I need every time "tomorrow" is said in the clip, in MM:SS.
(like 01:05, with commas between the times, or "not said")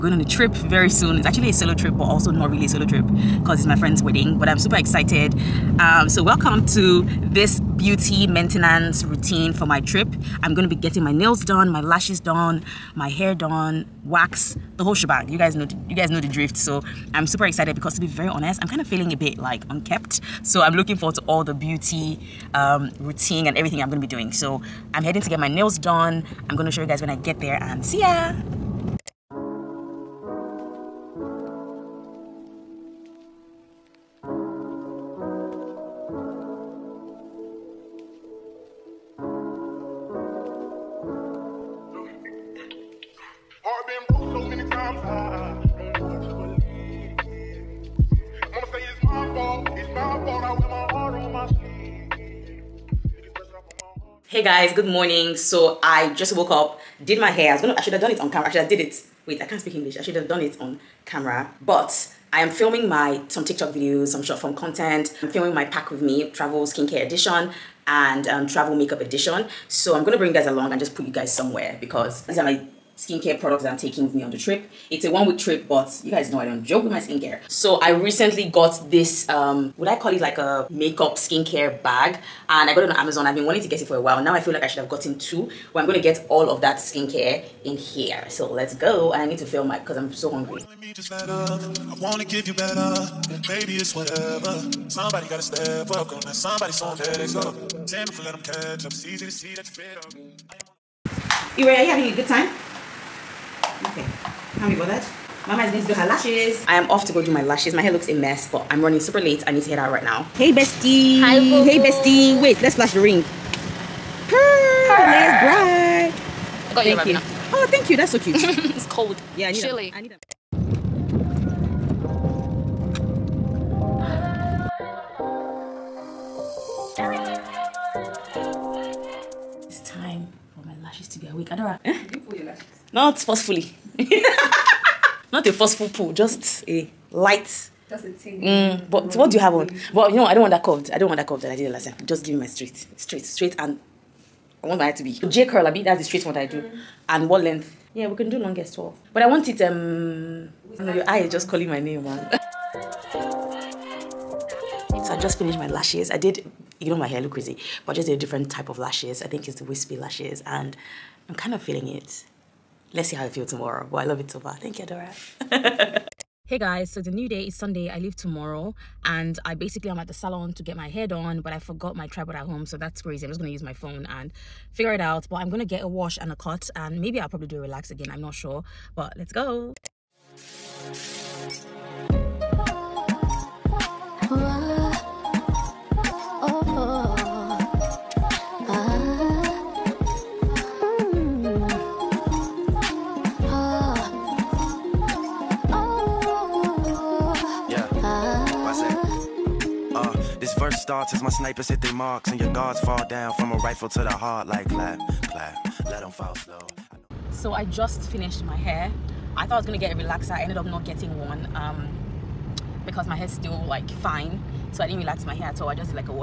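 02:43, 02:48.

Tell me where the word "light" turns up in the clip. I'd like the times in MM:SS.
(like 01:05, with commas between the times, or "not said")
02:17.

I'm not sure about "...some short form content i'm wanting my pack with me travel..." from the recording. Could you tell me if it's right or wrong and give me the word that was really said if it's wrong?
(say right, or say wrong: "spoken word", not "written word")
wrong: "filming", not "wanting".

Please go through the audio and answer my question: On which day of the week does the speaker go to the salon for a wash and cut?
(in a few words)
Sunday.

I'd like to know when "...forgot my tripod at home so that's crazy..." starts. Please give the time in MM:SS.
02:51.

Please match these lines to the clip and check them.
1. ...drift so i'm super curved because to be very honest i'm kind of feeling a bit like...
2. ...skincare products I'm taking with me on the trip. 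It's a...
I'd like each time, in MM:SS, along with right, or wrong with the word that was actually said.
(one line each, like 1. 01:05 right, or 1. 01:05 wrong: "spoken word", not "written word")
1. 00:16 wrong: "excited", not "curved"
2. 01:13 right.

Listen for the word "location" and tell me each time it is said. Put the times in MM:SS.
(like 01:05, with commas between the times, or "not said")
not said.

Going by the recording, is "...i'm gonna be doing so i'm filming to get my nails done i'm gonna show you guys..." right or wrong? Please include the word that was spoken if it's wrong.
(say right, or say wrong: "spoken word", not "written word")
wrong: "heading", not "filming".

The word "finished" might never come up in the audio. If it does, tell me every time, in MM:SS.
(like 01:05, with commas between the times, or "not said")
02:35, 03:28.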